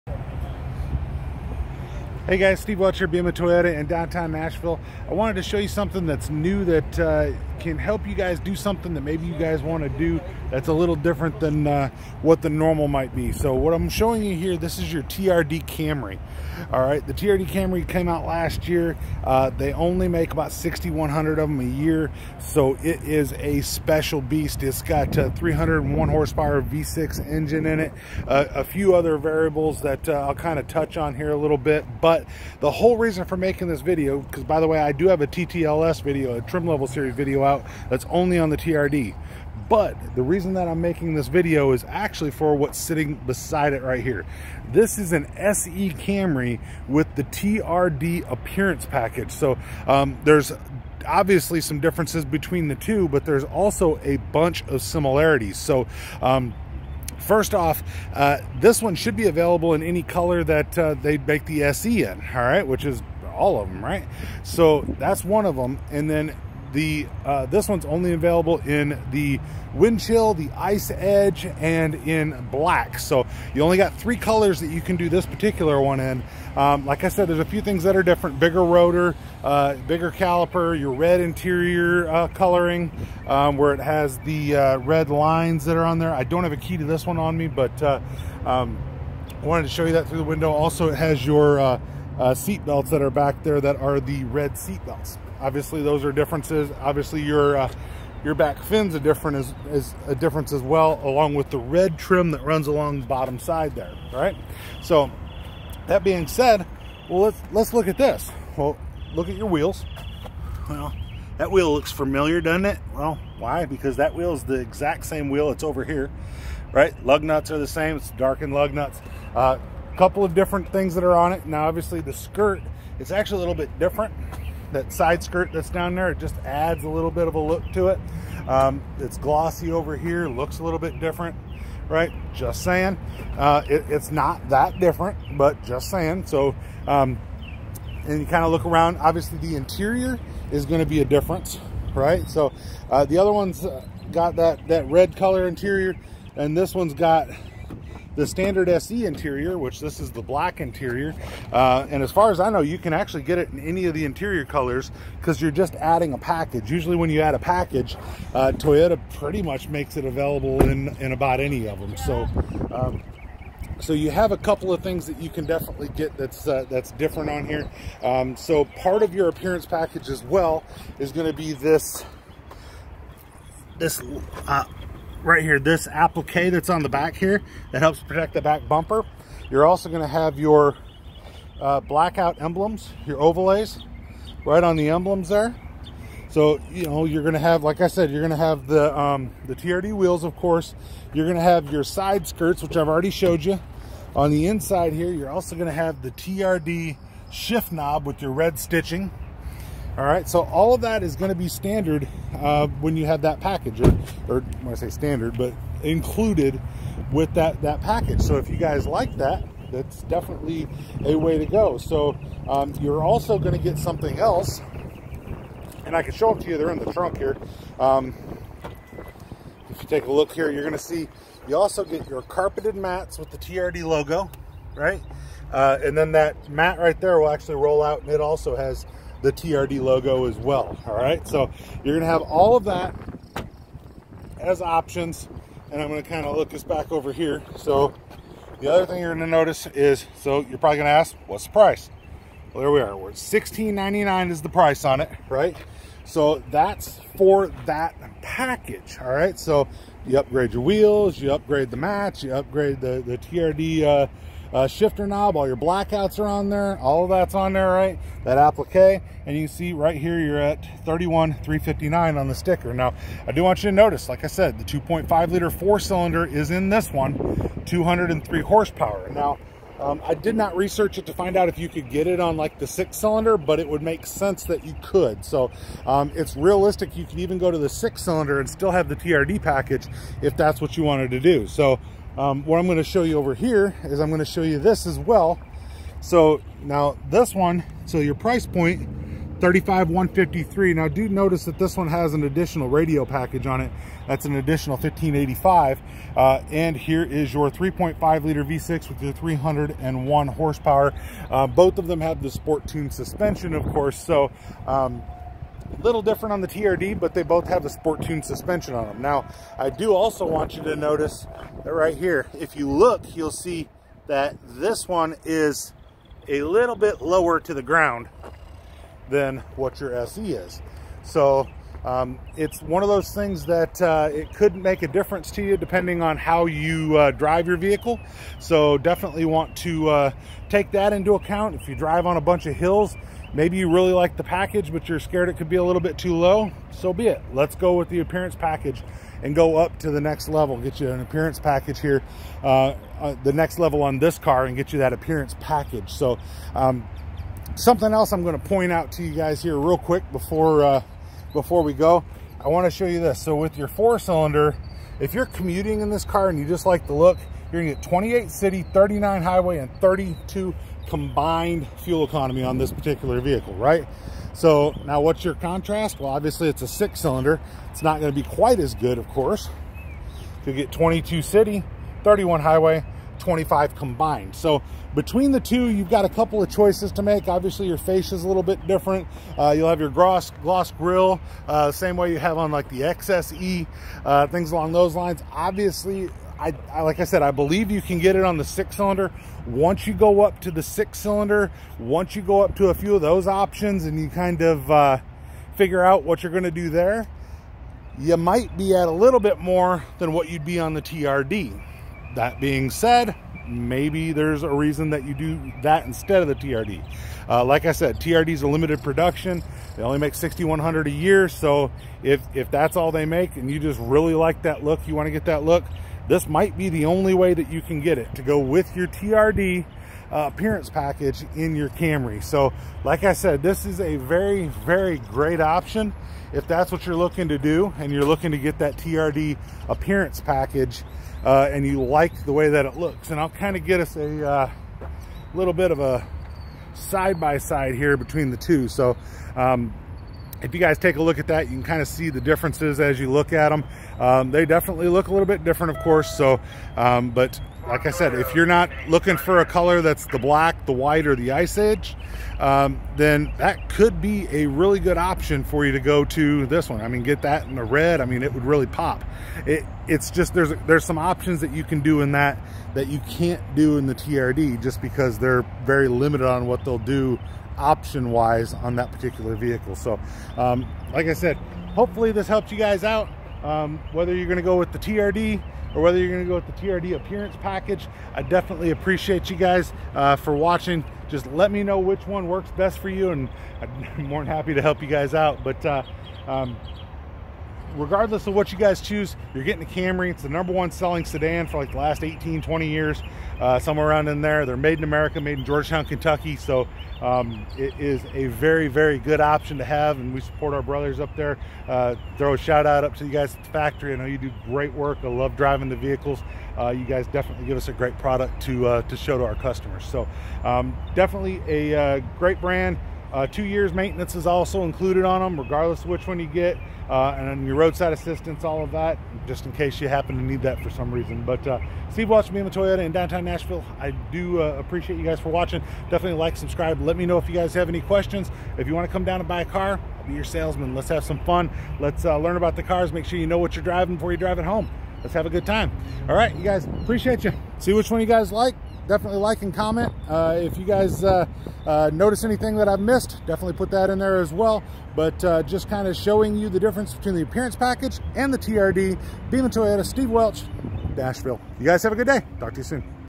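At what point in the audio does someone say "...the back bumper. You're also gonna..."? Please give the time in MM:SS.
02:58.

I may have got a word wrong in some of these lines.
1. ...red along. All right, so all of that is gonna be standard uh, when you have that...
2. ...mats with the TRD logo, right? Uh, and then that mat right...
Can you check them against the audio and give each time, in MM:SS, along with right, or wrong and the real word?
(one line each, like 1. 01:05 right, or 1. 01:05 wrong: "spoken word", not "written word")
1. 03:18 wrong: "stitching", not "along"
2. 03:42 right.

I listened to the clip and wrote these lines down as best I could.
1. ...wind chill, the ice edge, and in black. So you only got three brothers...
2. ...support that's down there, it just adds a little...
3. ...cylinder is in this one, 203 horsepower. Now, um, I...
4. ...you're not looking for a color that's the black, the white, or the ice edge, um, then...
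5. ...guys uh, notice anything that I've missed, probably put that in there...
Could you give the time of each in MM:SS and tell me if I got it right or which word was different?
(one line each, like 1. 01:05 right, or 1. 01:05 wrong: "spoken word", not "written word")
1. 01:09 wrong: "colors", not "brothers"
2. 02:05 wrong: "skirt", not "support"
3. 04:25 right
4. 07:28 right
5. 09:00 wrong: "definitely", not "probably".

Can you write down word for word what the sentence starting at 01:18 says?
Bigger rotor, uh, bigger caliper, your red interior uh, coloring, um, where it has the uh, red lines that are on there.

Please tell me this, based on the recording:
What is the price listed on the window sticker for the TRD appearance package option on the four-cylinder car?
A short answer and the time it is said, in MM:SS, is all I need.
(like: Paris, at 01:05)
$16.99, at 04:03.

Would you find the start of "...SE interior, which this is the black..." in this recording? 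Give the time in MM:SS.
02:28.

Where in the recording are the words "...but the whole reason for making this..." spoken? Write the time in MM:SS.
00:32.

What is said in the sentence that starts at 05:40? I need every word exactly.
Get you an appearance package here, uh, uh, the next level on this car and get you that appearance package.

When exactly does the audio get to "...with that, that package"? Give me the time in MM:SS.
03:27.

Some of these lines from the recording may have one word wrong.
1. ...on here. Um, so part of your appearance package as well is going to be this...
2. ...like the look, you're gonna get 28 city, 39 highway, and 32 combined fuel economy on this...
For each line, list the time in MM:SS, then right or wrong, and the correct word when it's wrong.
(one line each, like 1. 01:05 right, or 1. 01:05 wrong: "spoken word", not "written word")
1. 02:47 right
2. 05:56 right.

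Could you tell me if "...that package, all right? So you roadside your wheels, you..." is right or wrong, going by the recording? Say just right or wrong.
wrong.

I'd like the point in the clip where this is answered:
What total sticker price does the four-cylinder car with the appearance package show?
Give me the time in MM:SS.
04:20.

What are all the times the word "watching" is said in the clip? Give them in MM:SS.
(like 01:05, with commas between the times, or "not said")
08:00, 08:45.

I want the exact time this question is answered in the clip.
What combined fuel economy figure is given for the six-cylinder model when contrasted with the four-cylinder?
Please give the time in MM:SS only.
06:13.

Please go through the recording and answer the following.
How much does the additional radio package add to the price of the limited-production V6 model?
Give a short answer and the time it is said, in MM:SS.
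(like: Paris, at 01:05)
1,585, at 04:54.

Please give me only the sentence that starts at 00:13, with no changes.
So what I'm showing you here, this is your TRD Camry.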